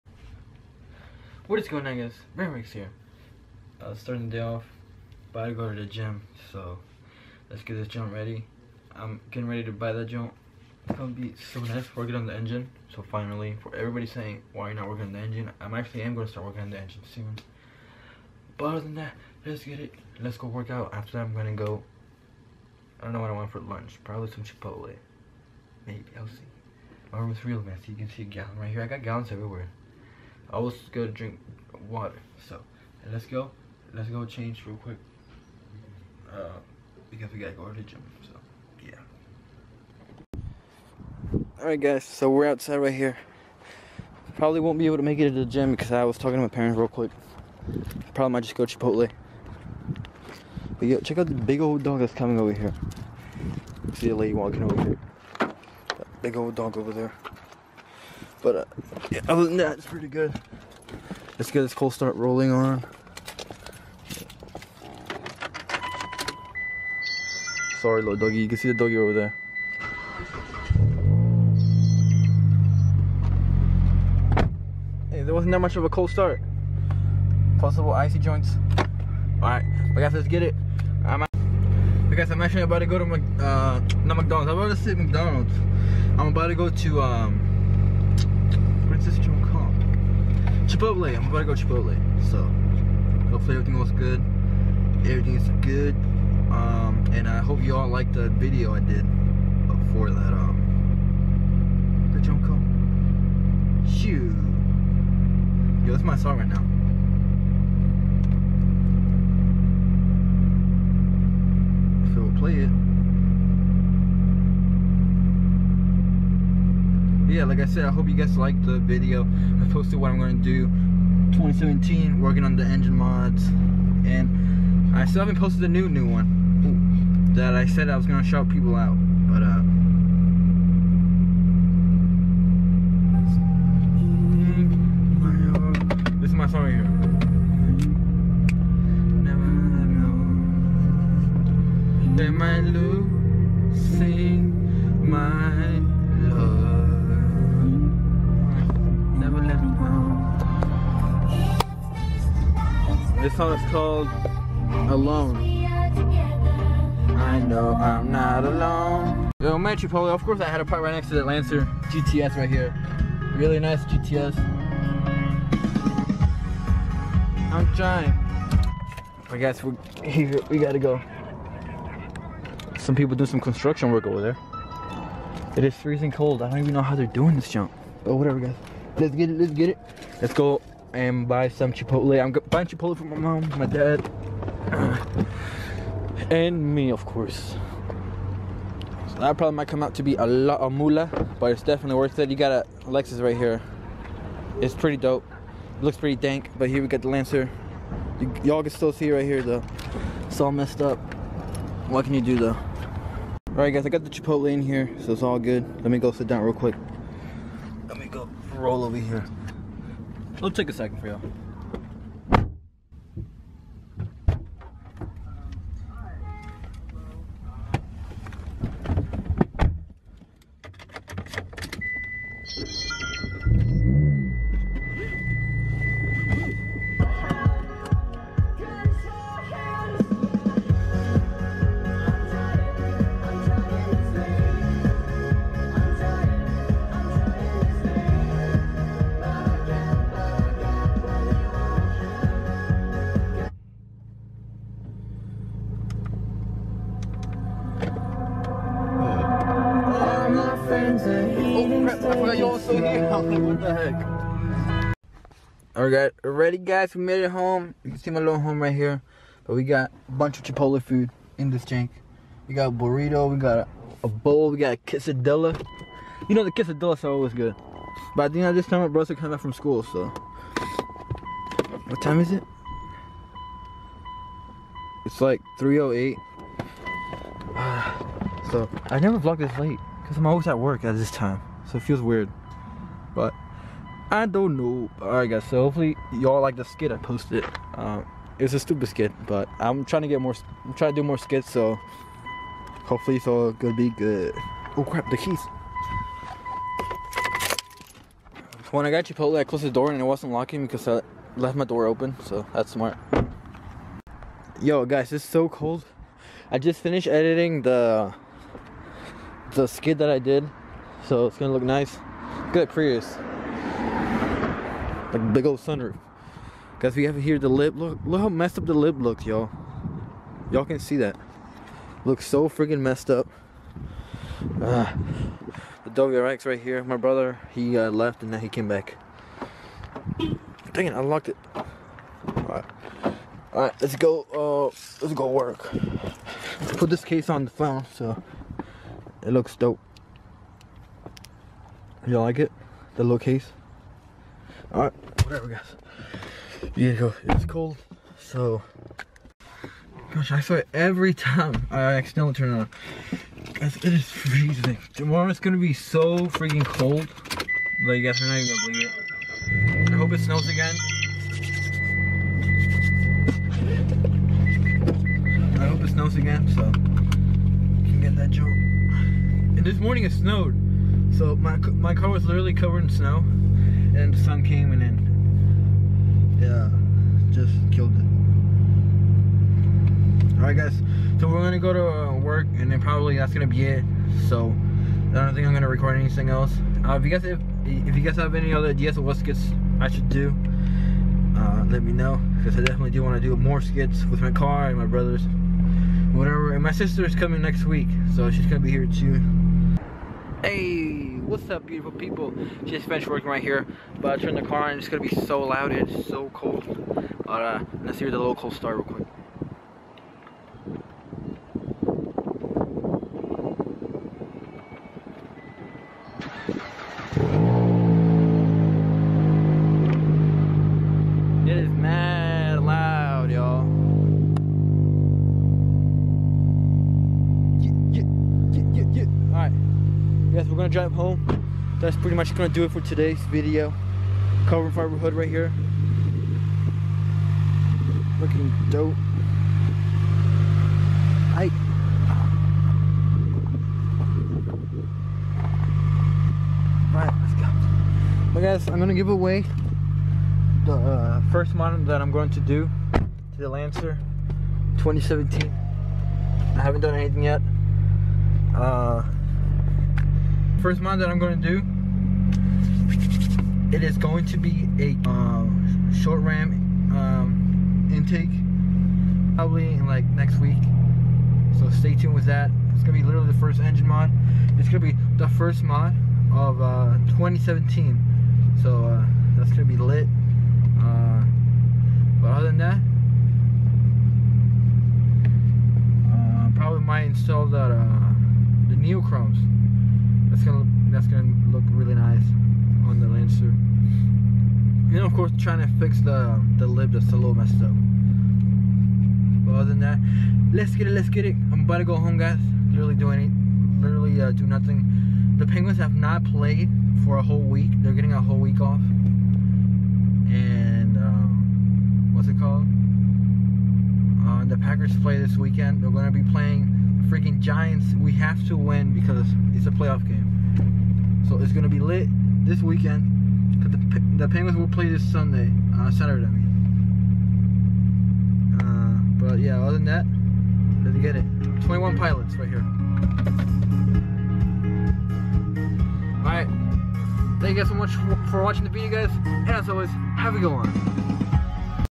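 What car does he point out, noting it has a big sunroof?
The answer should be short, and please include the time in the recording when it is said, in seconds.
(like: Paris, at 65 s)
Prius, at 312 s.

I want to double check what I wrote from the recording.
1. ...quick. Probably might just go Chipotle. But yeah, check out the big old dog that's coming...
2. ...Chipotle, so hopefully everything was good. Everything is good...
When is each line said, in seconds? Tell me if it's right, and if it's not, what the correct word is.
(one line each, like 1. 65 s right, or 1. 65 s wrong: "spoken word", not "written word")
1. 46 s right
2. 91 s right.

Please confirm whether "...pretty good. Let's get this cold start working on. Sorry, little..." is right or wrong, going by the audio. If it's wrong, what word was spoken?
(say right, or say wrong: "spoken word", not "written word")
wrong: "rolling", not "working".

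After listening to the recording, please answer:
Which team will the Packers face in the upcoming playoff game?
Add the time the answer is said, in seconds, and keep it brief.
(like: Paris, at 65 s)
Giants, at 517 s.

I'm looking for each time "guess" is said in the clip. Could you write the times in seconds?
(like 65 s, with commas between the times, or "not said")
169 s.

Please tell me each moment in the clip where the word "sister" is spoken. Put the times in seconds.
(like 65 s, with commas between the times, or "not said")
396 s.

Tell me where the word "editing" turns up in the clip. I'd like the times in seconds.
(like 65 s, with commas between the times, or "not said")
307 s.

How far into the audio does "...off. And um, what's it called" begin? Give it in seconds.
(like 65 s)
508 s.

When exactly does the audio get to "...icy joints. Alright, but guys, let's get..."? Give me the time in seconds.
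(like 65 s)
77 s.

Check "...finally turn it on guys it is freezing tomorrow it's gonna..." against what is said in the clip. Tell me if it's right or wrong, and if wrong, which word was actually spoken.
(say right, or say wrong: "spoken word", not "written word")
wrong: "accidentally", not "finally".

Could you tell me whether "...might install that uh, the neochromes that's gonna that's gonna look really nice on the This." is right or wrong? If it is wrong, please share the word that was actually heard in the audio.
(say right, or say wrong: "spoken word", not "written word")
wrong: "Lancer", not "This".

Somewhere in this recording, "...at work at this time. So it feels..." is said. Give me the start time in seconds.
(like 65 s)
280 s.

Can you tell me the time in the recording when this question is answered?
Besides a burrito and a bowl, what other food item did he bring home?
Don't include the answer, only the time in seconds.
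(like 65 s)
264 s.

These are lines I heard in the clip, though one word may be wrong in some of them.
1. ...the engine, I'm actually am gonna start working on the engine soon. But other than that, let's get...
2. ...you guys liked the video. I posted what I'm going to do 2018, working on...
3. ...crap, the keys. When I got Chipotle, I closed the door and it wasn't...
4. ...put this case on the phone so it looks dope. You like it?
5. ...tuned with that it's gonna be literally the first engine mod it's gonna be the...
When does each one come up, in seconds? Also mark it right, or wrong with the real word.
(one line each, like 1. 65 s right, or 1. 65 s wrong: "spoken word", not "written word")
1. 15 s right
2. 118 s wrong: "2017", not "2018"
3. 294 s right
4. 336 s right
5. 471 s right.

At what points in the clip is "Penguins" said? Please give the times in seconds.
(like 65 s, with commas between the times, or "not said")
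505 s, 524 s.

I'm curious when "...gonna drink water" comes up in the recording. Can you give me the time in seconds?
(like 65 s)
30 s.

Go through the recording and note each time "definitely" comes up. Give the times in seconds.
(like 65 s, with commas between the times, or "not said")
191 s, 392 s.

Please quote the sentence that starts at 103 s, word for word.
Shoot, yo, that's my song right now.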